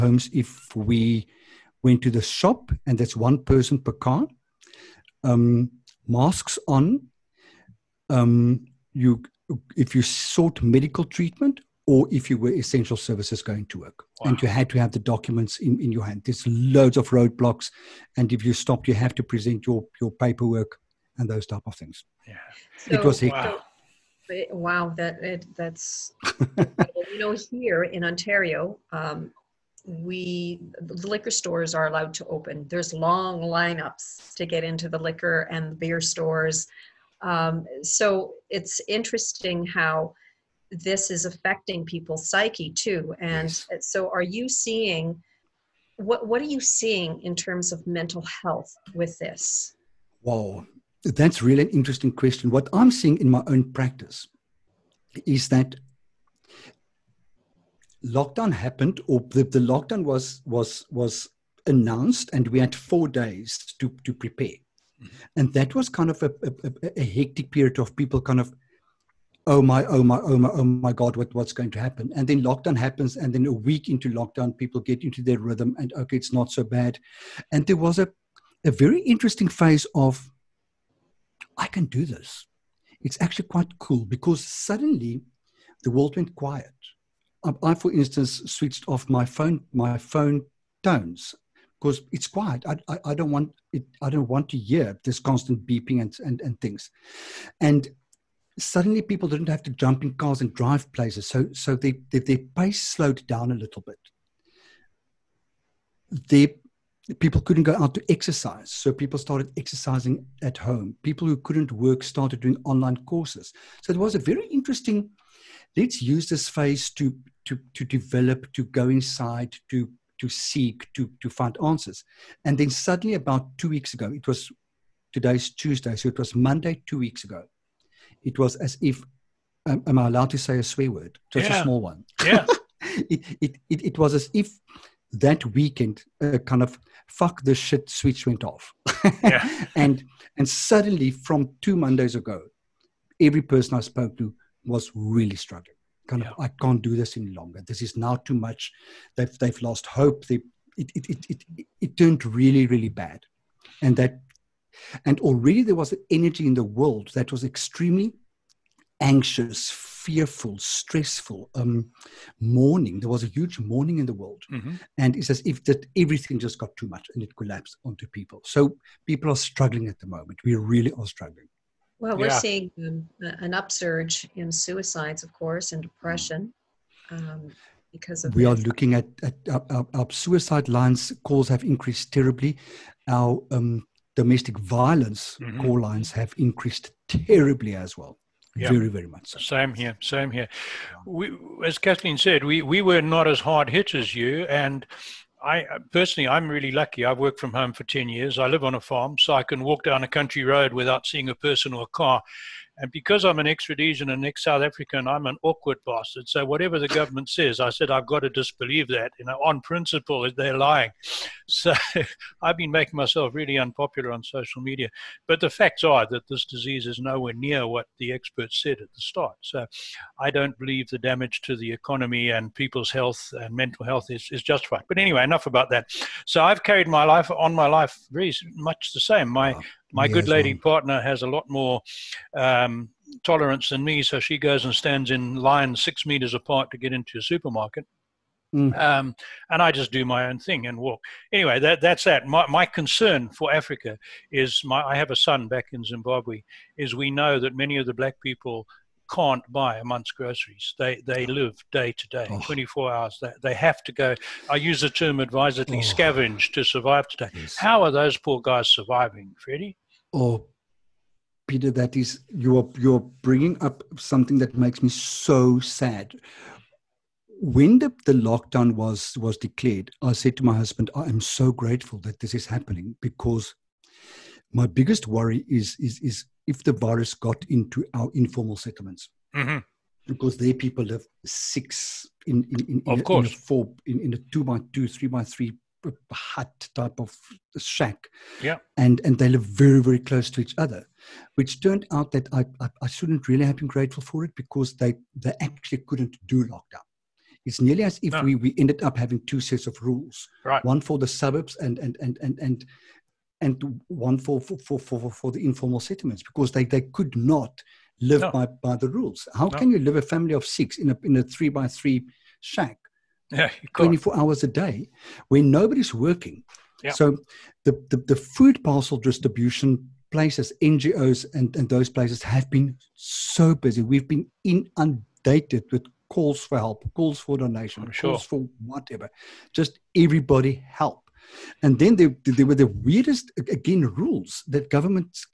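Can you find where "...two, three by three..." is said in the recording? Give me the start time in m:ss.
4:44.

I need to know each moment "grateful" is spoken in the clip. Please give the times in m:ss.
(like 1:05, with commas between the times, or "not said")
4:31, 4:53.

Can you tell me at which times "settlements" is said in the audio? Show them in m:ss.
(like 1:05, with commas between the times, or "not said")
4:38, 5:05.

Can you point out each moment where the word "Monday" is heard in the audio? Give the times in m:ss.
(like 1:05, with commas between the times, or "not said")
2:06, 2:21.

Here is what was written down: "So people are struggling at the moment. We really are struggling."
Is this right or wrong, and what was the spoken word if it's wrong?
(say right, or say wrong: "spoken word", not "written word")
right.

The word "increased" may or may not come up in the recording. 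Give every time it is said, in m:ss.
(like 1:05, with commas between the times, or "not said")
3:01, 3:06.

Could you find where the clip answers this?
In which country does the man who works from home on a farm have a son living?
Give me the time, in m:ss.
4:05.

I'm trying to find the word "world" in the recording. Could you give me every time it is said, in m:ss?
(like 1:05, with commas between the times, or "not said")
1:25, 2:36, 2:44.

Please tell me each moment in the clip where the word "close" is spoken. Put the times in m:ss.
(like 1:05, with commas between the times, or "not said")
4:49.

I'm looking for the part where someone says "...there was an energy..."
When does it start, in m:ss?
2:35.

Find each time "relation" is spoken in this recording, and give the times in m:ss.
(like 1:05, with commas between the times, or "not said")
not said.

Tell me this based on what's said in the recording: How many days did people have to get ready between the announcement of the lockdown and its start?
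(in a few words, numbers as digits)
4.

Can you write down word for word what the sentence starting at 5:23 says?
We've been inundated with calls for help, calls for donation, sure.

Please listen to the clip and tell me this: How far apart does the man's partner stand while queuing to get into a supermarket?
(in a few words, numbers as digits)
6 meters.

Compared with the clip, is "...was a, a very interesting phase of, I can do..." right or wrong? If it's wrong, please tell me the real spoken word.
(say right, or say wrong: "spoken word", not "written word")
right.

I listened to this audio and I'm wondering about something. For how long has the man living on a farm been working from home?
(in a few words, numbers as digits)
10 years.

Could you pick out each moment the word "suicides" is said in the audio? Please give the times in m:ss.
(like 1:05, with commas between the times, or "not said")
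2:54, 3:00.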